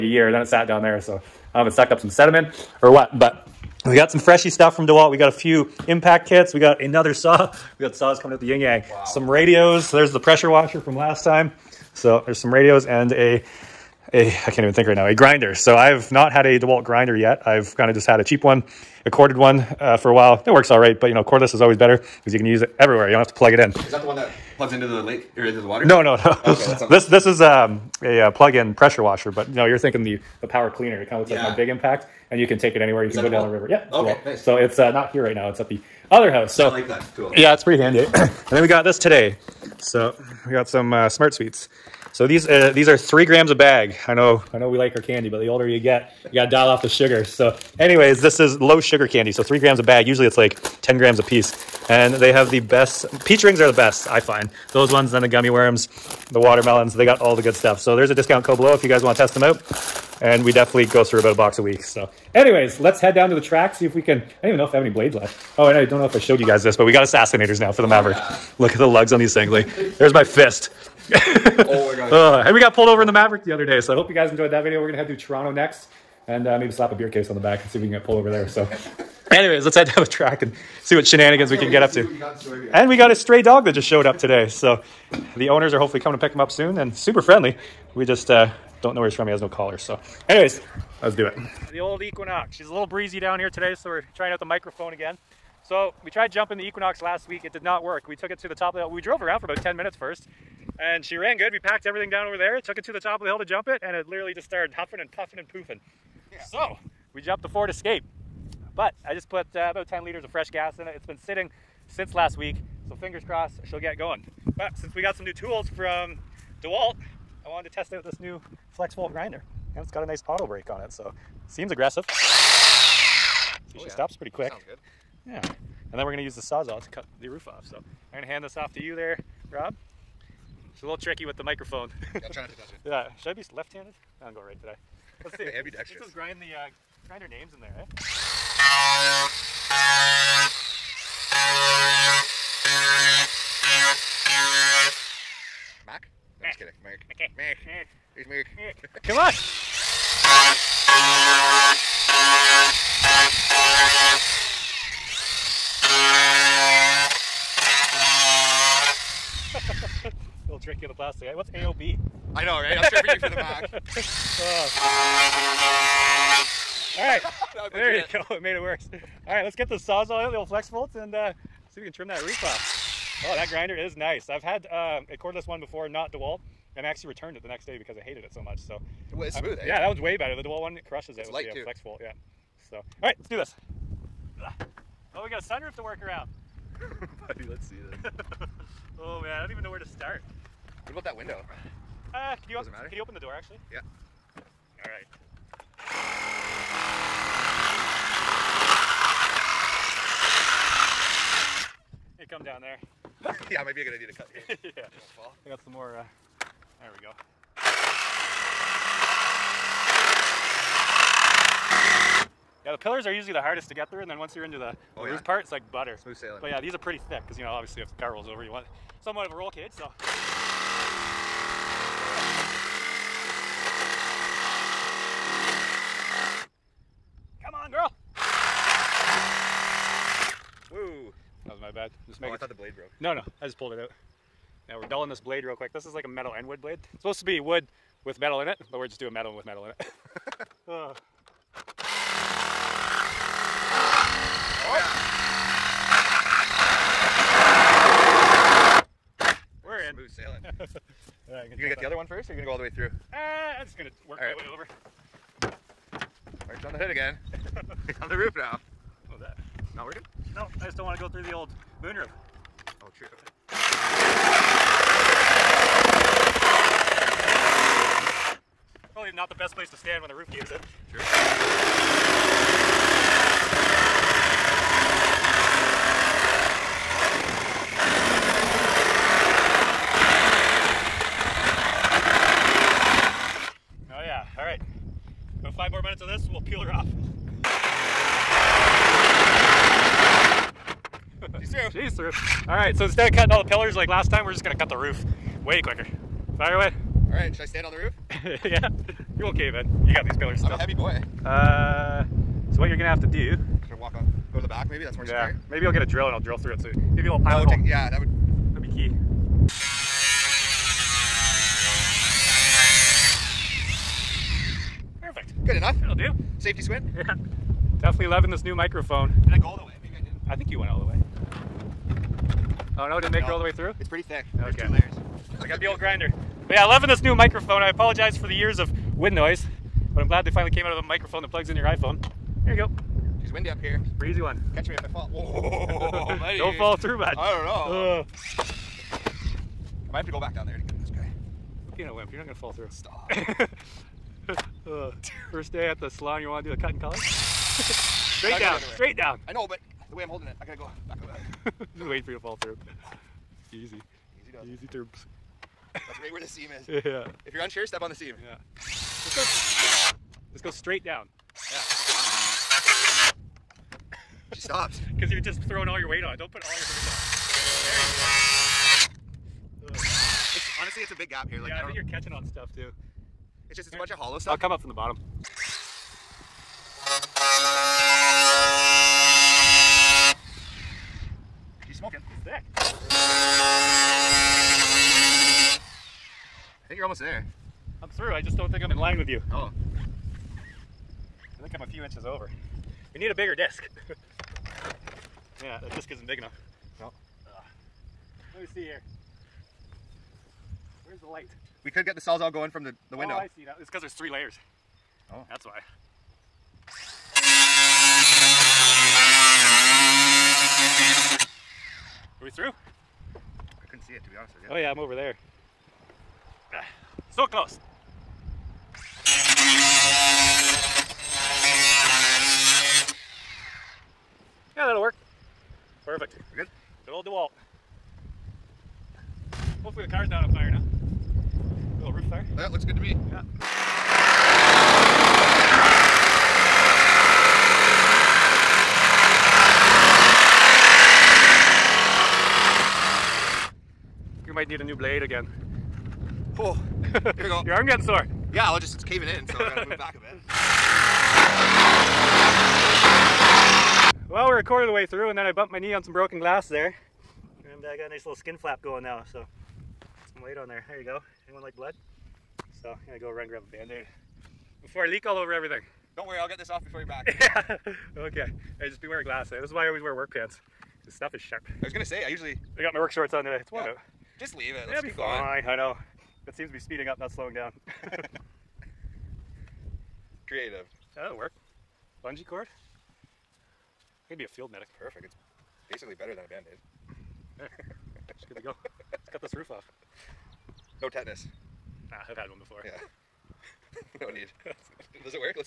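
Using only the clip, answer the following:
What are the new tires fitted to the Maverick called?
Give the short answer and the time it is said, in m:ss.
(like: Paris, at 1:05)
Assassinators, at 1:07.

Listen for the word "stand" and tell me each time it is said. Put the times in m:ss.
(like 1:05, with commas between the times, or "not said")
4:29, 4:57.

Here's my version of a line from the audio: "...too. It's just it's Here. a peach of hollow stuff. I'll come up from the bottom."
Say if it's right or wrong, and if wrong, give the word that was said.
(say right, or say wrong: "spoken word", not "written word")
wrong: "bunch", not "peach".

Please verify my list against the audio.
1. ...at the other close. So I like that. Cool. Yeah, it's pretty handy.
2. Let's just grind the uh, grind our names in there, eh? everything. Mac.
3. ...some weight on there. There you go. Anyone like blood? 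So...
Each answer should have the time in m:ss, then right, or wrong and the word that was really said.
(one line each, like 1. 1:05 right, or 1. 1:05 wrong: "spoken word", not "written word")
1. 0:35 wrong: "house", not "close"
2. 2:15 wrong: "kidding", not "everything"
3. 7:40 right.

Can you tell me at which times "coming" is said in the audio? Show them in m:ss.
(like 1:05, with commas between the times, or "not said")
0:08, 1:26.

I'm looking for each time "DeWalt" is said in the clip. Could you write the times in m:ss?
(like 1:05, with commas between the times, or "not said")
0:04, 0:16, 1:56, 2:56, 3:00, 7:07.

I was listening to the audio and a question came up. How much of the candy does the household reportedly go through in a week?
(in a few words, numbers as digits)
About a box.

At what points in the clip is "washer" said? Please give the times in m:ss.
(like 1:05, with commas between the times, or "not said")
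0:10, 0:29.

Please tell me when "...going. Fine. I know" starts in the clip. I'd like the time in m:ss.
7:54.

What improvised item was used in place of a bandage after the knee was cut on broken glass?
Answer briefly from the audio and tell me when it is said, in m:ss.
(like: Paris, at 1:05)
Bungee cord, at 8:02.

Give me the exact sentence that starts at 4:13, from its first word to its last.
Uh, I'm just gonna work all right.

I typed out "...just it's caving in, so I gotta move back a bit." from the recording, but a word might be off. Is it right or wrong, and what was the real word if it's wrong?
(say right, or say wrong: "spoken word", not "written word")
right.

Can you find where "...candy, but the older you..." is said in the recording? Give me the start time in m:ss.
0:45.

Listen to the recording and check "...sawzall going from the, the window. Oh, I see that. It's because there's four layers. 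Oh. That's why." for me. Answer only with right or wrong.
wrong.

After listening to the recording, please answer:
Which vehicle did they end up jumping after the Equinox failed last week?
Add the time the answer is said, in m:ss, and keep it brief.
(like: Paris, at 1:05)
Ford Escape, at 1:47.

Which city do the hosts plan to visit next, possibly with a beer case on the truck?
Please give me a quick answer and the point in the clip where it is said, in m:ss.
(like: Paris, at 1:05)
Toronto, at 1:15.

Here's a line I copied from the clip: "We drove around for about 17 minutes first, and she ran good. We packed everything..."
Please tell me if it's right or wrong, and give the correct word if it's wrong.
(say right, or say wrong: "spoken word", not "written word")
wrong: "10", not "17".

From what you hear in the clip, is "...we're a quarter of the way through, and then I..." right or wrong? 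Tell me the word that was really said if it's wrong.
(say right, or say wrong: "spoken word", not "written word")
right.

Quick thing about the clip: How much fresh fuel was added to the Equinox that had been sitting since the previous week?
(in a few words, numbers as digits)
10 liters.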